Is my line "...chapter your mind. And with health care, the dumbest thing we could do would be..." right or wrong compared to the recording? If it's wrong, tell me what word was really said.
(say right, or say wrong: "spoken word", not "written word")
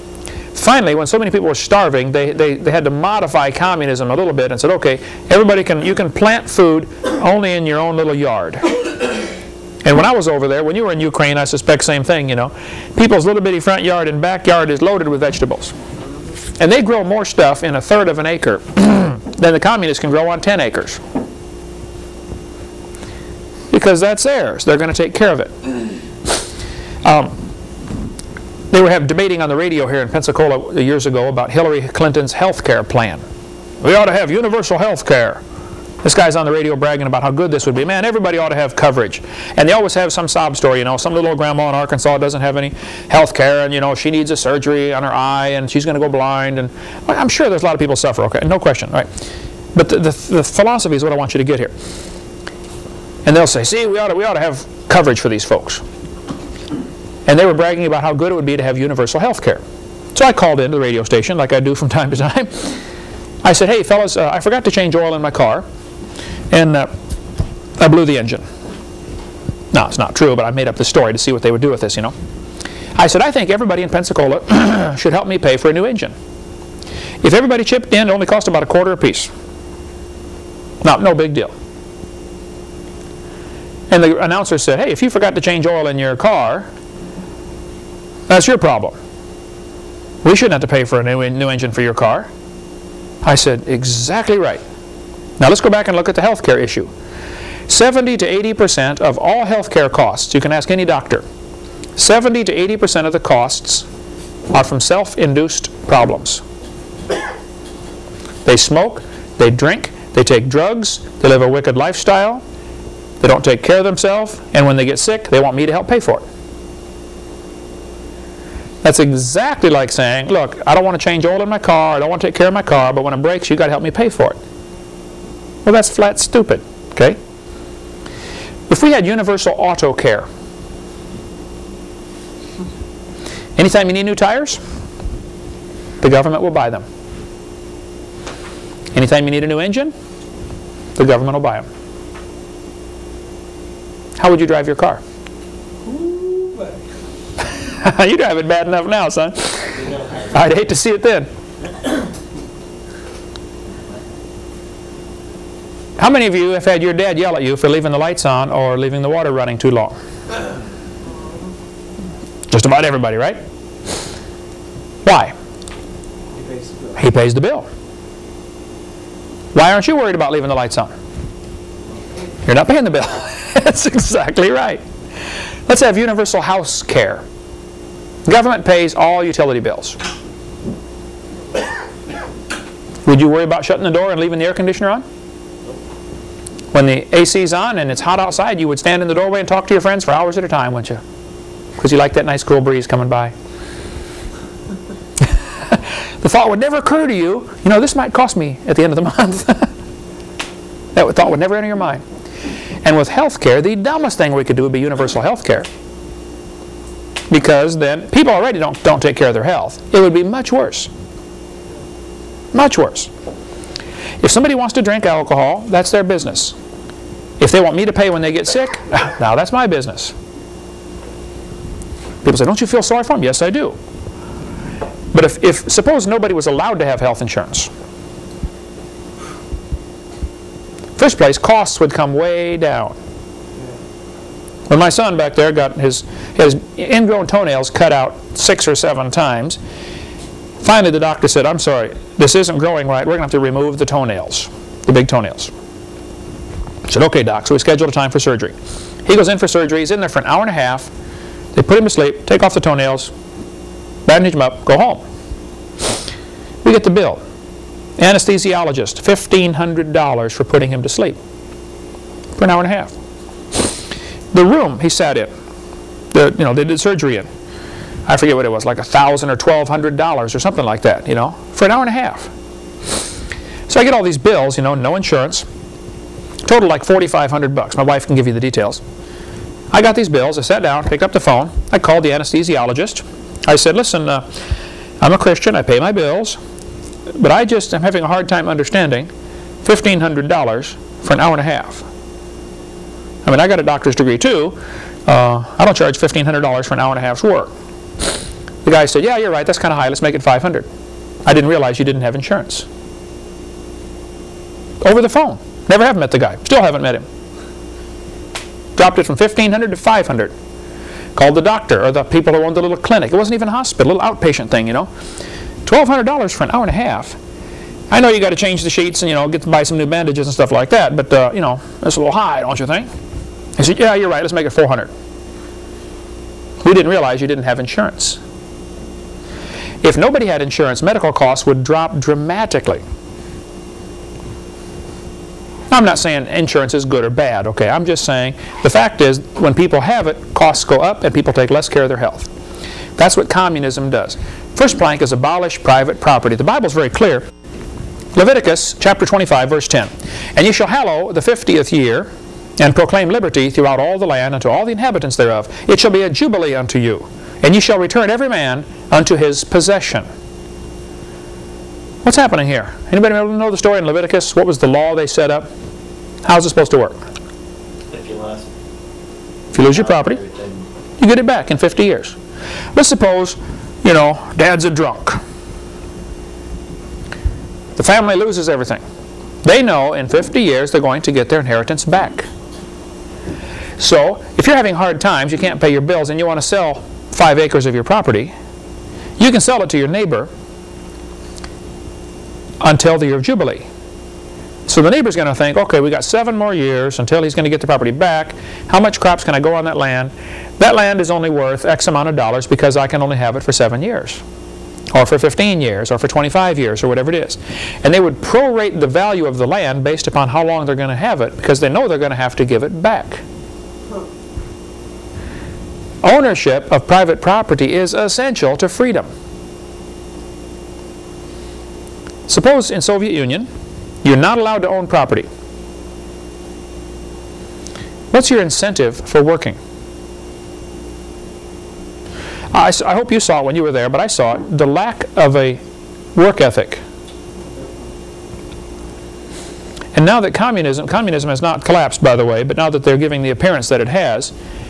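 wrong: "enter", not "chapter".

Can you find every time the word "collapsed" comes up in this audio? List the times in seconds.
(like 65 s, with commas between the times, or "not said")
441 s.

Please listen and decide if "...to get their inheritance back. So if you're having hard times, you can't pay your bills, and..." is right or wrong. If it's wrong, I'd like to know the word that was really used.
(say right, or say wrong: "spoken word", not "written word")
right.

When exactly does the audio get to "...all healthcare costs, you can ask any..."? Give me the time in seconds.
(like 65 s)
99 s.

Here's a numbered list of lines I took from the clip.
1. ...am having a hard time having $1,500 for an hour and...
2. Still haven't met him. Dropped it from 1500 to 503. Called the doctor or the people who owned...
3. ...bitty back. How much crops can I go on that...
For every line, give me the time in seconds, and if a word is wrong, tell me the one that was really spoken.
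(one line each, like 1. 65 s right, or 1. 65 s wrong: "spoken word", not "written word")
1. 287 s wrong: "understanding", not "having"
2. 306 s wrong: "500", not "503"
3. 397 s wrong: "property", not "bitty".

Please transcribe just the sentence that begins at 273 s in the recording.
So I get all these bills, you know, no insurance, total like forty-five hundred bucks.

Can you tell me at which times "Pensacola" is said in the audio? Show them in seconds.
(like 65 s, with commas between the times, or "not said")
30 s, 73 s.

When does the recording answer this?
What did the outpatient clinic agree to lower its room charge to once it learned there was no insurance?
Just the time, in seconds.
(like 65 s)
324 s.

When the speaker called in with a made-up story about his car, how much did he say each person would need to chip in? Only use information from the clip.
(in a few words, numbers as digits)
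A quarter.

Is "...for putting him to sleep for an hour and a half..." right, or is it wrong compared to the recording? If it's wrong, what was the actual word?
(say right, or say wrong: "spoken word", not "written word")
right.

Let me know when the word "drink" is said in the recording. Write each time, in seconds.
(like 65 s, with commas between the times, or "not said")
109 s, 214 s.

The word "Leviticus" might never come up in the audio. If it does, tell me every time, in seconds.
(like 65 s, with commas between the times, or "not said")
348 s, 363 s.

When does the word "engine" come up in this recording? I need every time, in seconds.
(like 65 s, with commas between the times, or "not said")
68 s, 75 s, 91 s, 139 s.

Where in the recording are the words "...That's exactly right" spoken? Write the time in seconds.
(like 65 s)
173 s.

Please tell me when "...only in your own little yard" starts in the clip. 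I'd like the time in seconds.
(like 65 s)
7 s.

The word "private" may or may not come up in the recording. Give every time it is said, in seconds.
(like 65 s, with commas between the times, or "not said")
345 s, 416 s.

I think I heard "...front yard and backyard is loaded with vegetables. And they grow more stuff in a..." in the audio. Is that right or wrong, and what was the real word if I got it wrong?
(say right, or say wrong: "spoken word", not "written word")
right.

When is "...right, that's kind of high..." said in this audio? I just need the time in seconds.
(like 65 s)
299 s.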